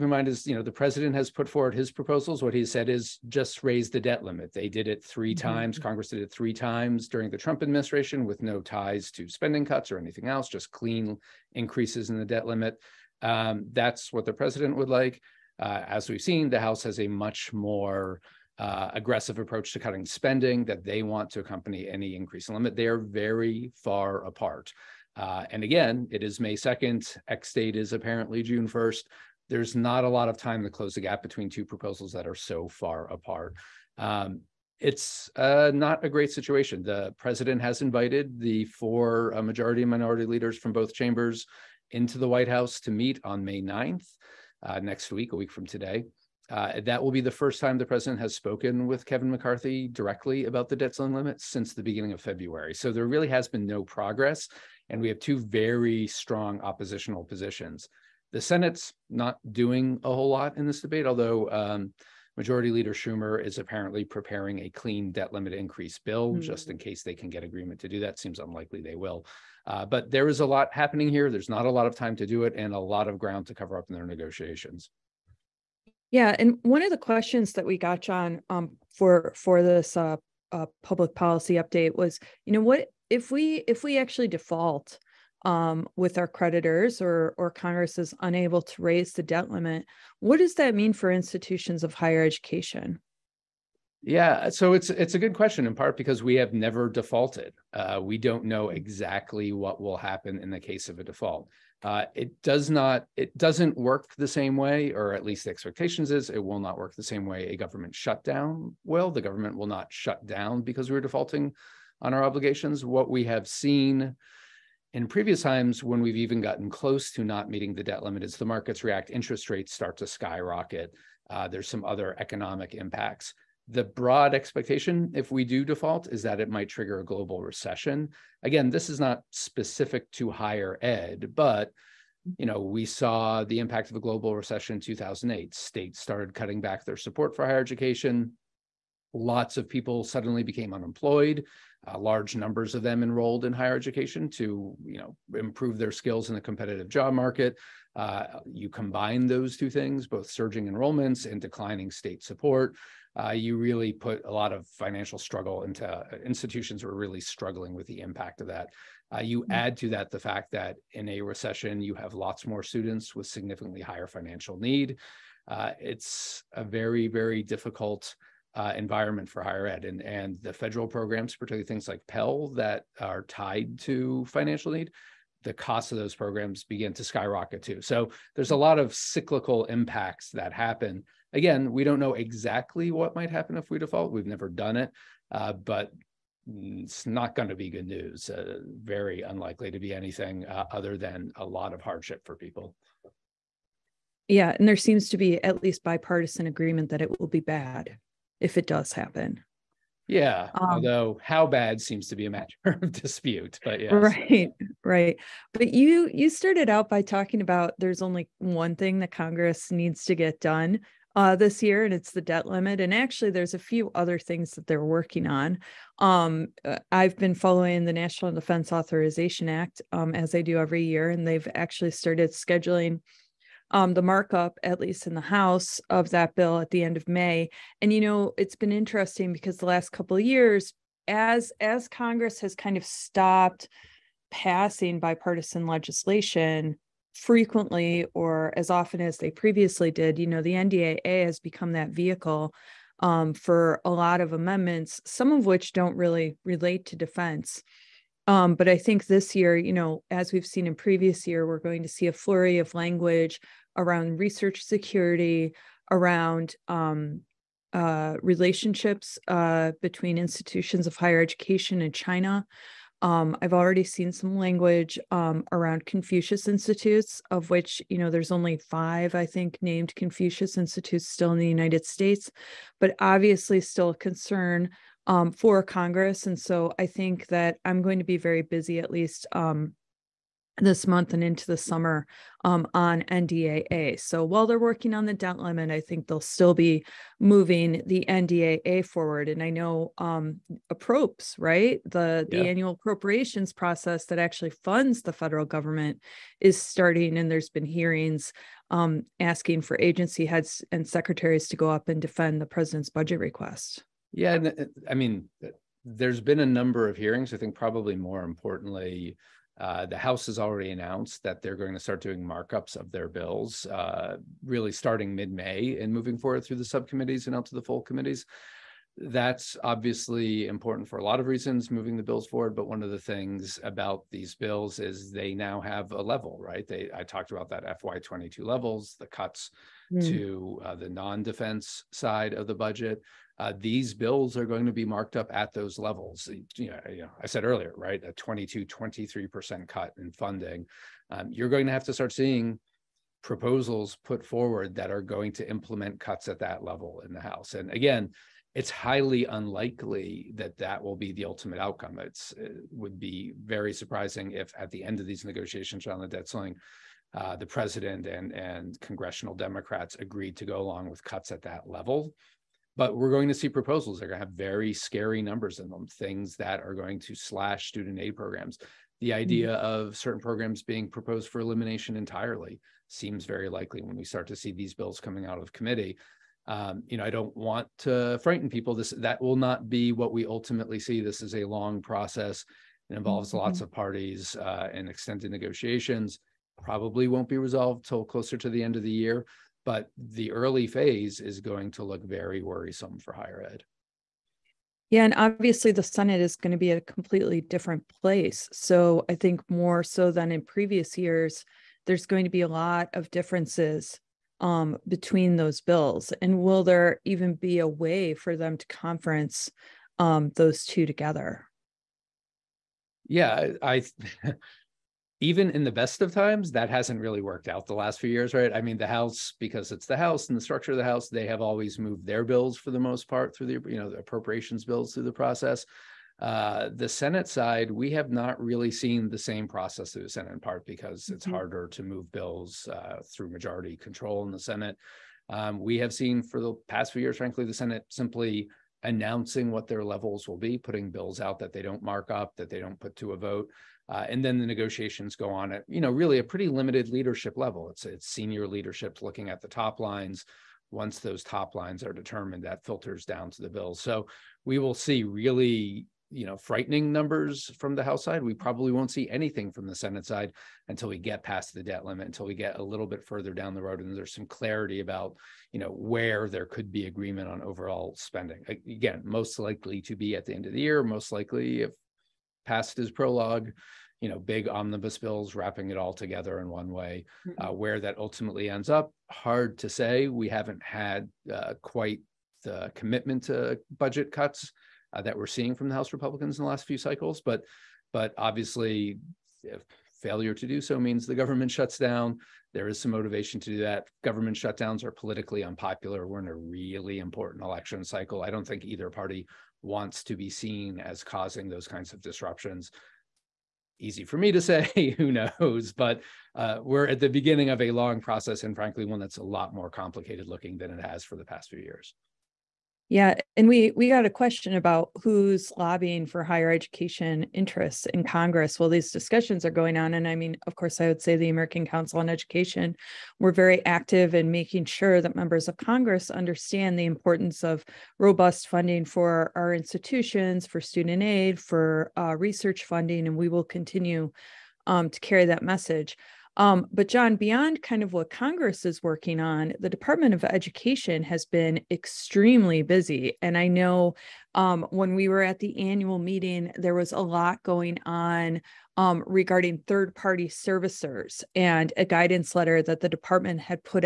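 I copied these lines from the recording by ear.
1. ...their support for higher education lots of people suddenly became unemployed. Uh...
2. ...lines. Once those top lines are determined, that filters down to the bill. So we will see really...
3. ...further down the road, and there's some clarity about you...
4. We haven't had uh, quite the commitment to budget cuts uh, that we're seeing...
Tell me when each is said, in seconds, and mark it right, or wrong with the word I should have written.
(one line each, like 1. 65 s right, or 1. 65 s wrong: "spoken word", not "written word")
1. 136 s right
2. 449 s right
3. 463 s right
4. 480 s right.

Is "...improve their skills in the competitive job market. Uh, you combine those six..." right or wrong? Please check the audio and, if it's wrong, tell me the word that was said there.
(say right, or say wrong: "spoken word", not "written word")
wrong: "two", not "six".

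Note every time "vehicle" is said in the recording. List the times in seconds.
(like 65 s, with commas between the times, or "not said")
241 s.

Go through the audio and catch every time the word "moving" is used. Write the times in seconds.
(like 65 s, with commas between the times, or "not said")
287 s, 315 s, 321 s.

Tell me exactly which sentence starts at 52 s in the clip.
So there really has been no progress and we have two very strong oppositional positions.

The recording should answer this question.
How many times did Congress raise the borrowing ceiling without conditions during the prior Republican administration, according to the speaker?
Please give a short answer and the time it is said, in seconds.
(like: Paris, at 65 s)
3, at 6 s.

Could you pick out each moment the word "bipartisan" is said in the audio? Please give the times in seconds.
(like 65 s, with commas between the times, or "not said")
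195 s, 234 s.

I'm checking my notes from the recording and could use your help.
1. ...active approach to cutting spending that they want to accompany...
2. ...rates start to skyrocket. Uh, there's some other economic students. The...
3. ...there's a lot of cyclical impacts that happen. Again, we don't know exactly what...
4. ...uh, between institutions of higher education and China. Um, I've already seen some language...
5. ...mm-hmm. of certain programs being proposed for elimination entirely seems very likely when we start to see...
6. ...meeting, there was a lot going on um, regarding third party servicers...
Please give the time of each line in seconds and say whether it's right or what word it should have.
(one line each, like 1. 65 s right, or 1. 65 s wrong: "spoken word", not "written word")
1. 18 s wrong: "aggressive", not "active"
2. 119 s wrong: "impacts", not "students"
3. 178 s right
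4. 259 s right
5. 369 s right
6. 545 s right.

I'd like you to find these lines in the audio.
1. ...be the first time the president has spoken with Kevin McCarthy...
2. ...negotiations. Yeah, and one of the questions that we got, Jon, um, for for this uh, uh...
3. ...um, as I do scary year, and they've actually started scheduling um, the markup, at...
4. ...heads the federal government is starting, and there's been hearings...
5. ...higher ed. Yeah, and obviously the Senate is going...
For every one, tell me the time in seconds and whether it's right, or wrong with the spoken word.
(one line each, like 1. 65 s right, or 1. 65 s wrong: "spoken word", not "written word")
1. 47 s right
2. 74 s right
3. 219 s wrong: "every", not "scary"
4. 294 s wrong: "funds", not "heads"
5. 393 s right.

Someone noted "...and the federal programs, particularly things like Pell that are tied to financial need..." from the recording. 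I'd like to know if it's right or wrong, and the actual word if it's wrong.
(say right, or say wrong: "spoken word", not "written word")
right.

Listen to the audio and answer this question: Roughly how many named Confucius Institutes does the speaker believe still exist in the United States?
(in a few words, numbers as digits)
5.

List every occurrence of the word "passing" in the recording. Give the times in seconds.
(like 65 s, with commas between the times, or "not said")
234 s.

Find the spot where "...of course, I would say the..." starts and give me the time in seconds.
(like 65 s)
520 s.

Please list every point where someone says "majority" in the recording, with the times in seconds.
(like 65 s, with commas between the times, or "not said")
39 s, 62 s, 433 s.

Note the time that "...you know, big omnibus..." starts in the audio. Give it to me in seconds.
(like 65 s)
473 s.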